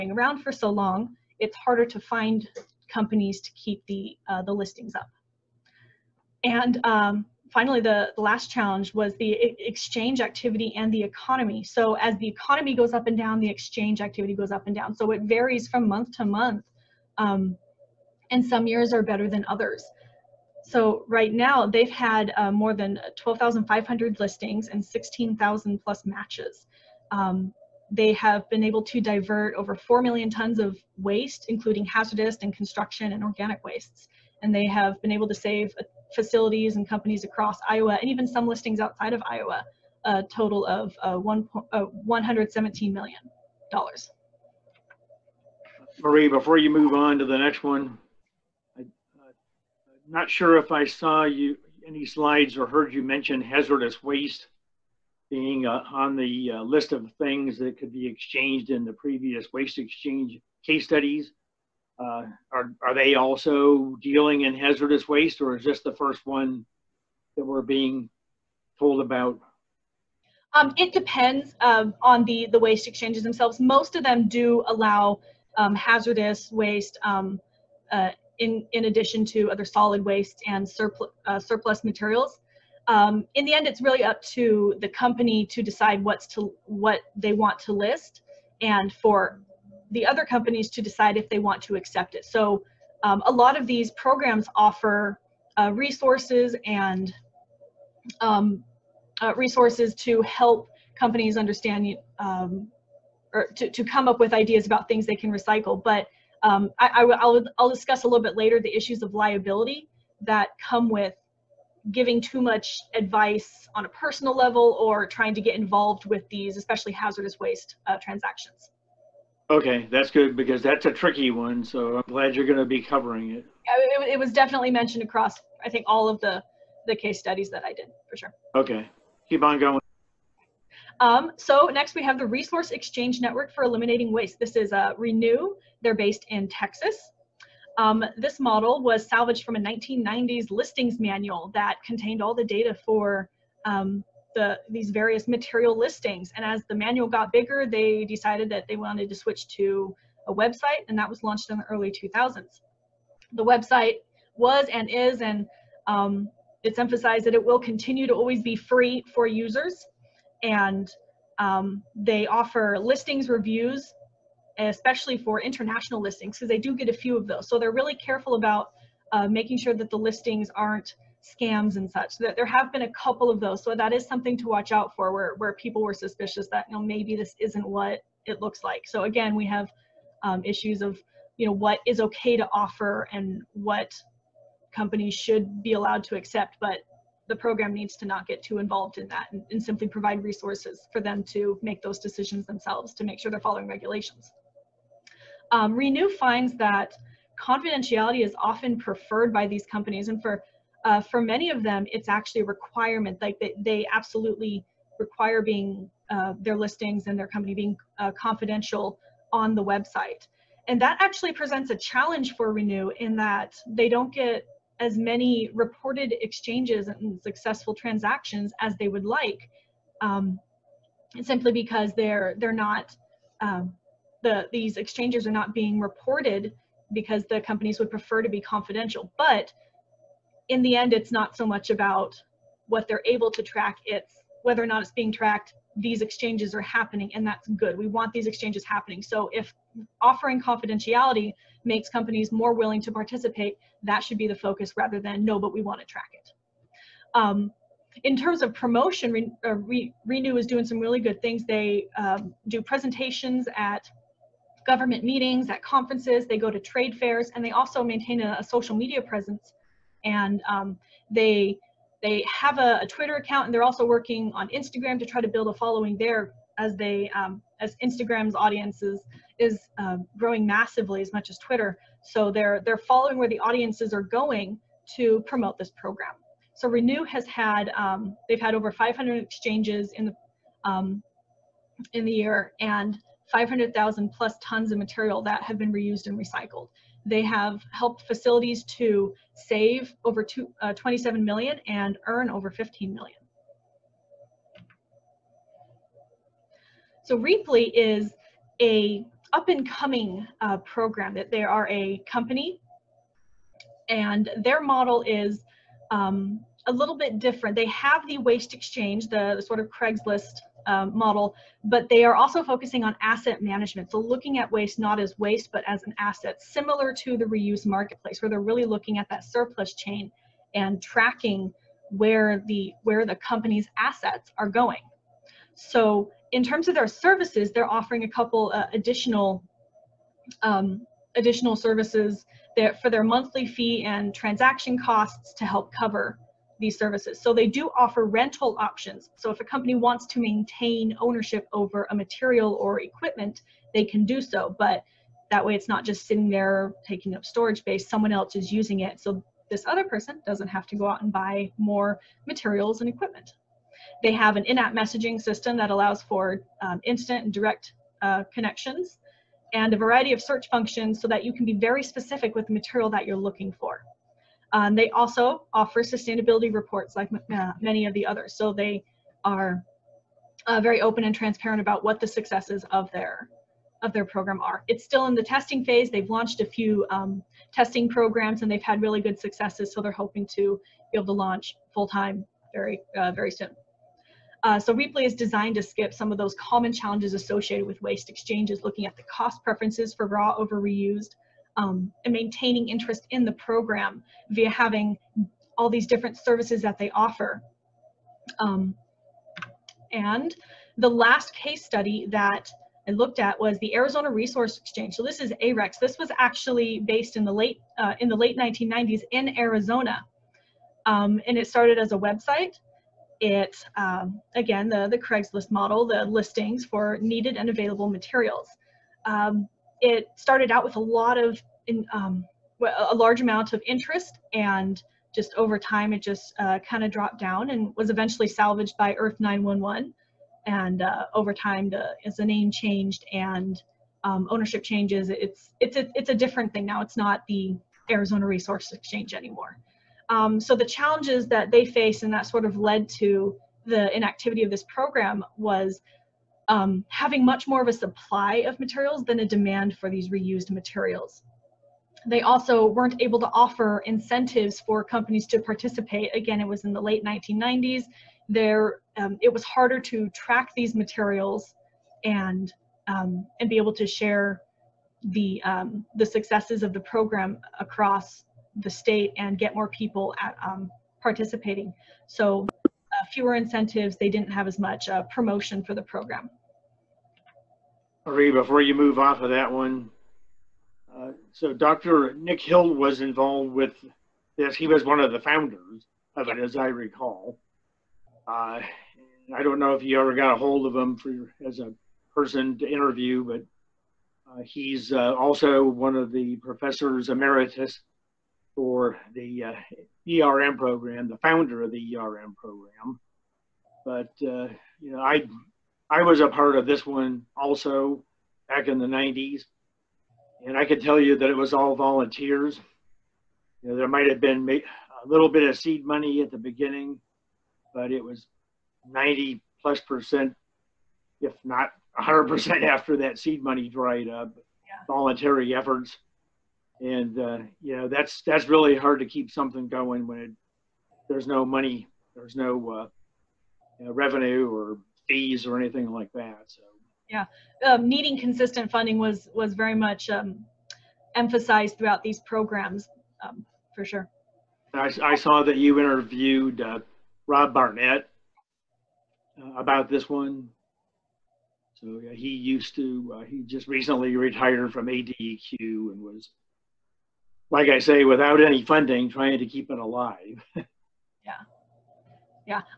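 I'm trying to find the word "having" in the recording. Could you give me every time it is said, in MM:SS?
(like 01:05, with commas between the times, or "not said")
06:34, 07:26.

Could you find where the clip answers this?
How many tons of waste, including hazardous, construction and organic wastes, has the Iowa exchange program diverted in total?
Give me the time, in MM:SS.
00:29.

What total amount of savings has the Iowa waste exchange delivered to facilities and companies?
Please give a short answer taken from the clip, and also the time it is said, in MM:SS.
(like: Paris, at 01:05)
$117 million, at 00:42.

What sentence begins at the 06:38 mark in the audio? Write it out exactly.
Um, and the last case study that I looked at was the Arizona Resource Exchange.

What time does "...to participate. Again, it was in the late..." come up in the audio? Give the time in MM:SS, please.
07:35.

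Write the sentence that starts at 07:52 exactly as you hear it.
So uh, fewer incentives, they didn't have as much uh, promotion for the program.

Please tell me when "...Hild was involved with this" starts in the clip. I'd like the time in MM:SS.
08:02.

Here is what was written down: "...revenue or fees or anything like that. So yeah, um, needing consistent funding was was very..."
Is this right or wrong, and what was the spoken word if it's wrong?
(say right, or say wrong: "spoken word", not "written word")
right.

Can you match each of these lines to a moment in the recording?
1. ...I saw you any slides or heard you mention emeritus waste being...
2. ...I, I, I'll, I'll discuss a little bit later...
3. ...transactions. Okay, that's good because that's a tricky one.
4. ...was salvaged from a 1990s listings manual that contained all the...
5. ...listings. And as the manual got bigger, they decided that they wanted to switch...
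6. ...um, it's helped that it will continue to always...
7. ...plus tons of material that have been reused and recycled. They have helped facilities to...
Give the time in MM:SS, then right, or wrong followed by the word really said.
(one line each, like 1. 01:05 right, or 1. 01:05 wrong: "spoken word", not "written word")
1. 00:50 wrong: "hazardous", not "emeritus"
2. 01:46 right
3. 01:58 right
4. 02:18 right
5. 02:25 right
6. 02:35 wrong: "emphasized", not "helped"
7. 04:44 right.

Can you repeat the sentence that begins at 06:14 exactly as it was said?
It's still in the testing phase.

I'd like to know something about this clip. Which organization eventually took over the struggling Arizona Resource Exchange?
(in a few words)
Earth 911.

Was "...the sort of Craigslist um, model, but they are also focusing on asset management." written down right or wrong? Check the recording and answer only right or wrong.
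right.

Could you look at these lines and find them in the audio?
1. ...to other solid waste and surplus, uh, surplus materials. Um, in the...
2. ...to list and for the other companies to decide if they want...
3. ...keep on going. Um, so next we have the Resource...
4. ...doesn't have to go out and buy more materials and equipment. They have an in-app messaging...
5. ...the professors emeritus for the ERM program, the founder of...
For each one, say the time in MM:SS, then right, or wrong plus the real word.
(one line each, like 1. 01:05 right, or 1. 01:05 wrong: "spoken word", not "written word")
1. 01:19 right
2. 01:27 right
3. 02:09 right
4. 05:50 right
5. 08:16 right.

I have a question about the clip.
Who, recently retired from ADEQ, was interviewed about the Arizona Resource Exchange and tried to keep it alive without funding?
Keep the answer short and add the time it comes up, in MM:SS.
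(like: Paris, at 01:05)
Rob Barnett, at 09:07.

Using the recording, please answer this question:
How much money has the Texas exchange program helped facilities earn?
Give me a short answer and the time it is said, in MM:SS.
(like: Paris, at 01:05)
over 15 million, at 04:52.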